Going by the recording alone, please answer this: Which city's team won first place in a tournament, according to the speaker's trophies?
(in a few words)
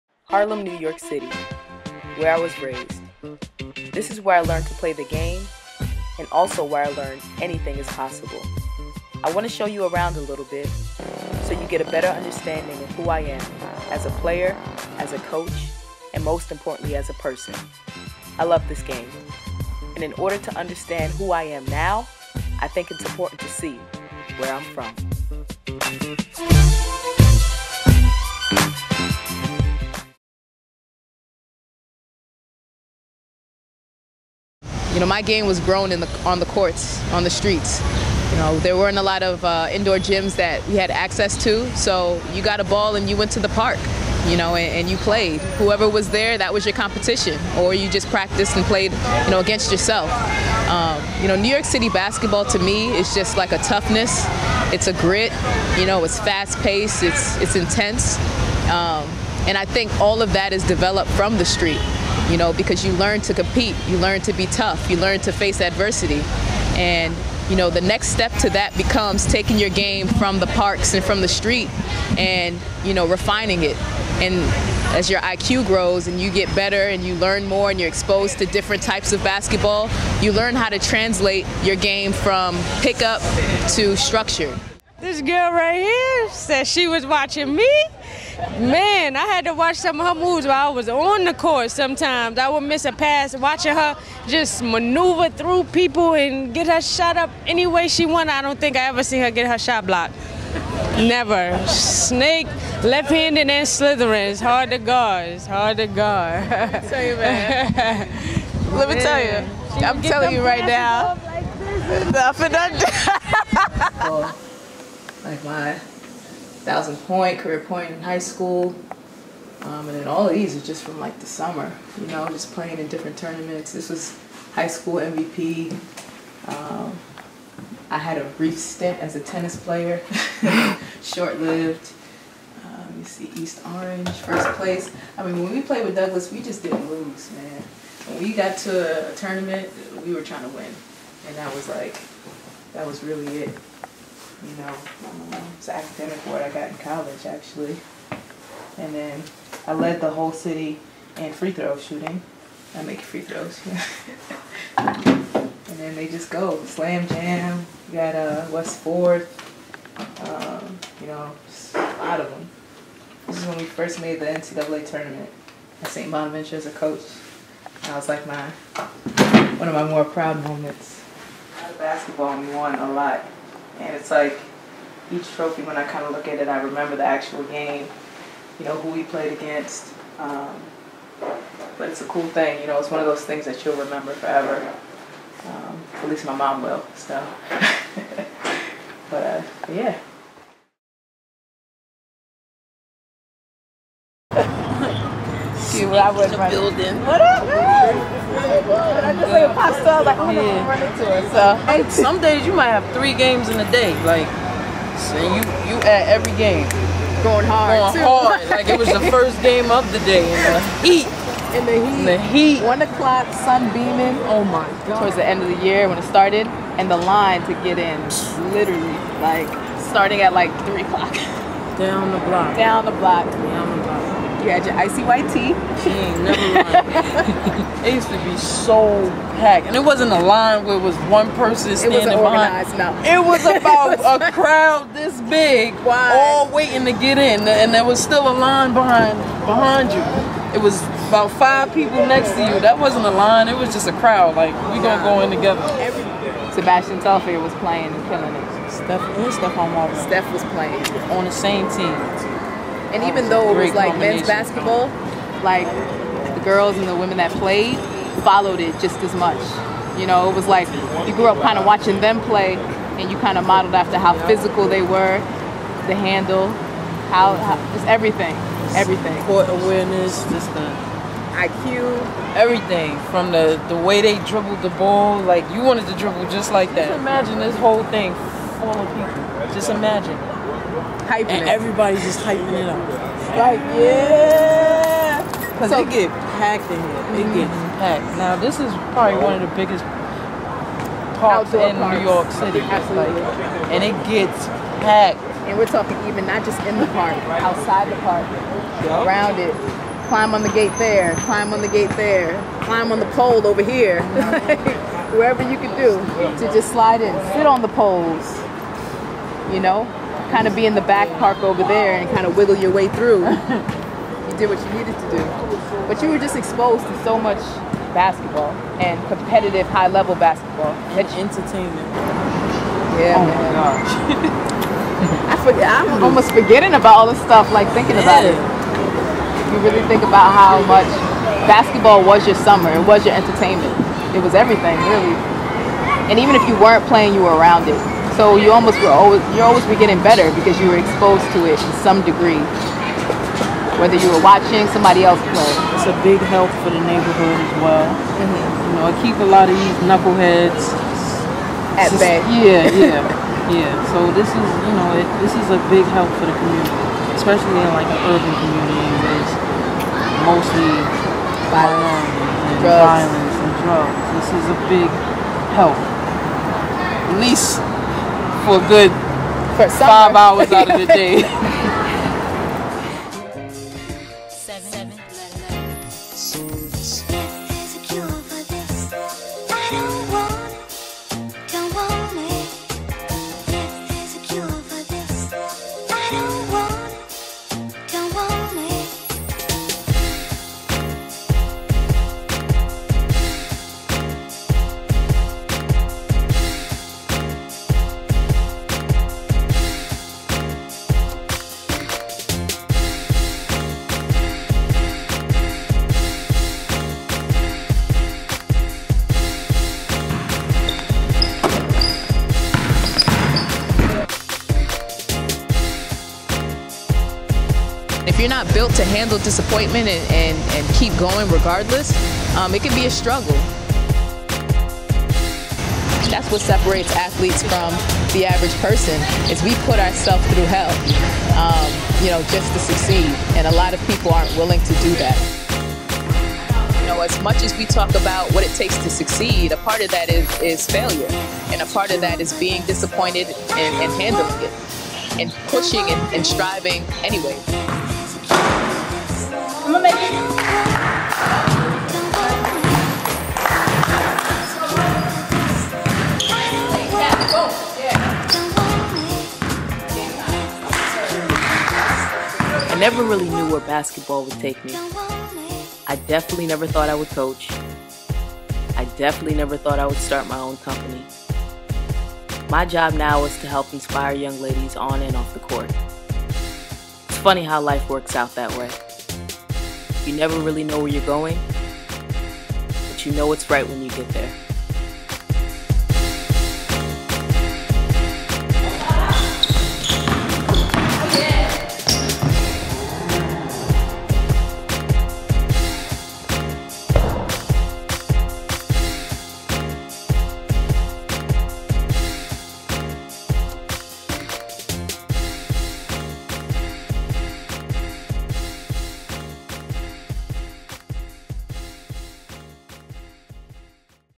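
East Orange.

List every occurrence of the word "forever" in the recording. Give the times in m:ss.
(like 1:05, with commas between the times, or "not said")
3:04.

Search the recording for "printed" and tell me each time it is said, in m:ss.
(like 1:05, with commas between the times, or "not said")
not said.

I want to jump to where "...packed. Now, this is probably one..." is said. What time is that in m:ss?
4:47.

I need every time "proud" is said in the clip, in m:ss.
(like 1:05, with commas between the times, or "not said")
2:50.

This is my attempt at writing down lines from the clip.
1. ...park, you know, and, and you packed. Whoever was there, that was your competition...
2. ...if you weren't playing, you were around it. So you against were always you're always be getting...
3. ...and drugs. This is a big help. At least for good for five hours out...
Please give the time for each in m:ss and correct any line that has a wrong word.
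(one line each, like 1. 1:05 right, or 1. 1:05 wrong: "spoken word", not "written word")
1. 0:43 wrong: "played", not "packed"
2. 5:36 wrong: "almost", not "against"
3. 6:03 right.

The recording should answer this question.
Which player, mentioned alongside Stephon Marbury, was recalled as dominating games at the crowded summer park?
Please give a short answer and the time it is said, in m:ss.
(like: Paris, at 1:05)
Sebastian Telfair, at 4:06.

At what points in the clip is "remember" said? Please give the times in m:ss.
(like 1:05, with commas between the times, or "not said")
2:56, 3:03.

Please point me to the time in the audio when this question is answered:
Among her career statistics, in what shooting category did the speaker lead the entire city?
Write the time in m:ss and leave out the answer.
2:31.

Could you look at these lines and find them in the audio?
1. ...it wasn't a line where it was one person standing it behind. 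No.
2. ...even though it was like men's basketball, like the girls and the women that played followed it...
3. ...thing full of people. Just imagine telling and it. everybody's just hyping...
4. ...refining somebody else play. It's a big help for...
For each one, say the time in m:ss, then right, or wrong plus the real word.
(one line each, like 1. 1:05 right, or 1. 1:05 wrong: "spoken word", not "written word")
1. 3:49 right
2. 4:13 right
3. 4:37 wrong: "hyping", not "telling"
4. 5:44 wrong: "watching", not "refining".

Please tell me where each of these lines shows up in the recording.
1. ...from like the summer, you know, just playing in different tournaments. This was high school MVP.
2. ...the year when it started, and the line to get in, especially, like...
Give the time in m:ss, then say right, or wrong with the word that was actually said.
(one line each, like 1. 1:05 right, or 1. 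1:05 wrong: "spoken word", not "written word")
1. 2:00 right
2. 3:35 wrong: "literally", not "especially".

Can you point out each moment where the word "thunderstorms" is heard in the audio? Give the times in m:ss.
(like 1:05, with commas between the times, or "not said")
not said.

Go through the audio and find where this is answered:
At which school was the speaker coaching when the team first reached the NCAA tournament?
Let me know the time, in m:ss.
2:45.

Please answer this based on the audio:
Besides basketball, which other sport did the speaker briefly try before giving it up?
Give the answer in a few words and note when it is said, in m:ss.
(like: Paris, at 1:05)
Tennis, at 2:09.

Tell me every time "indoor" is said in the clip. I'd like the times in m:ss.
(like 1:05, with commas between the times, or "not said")
0:39.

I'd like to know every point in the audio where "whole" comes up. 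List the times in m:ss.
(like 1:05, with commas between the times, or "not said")
2:30, 4:37.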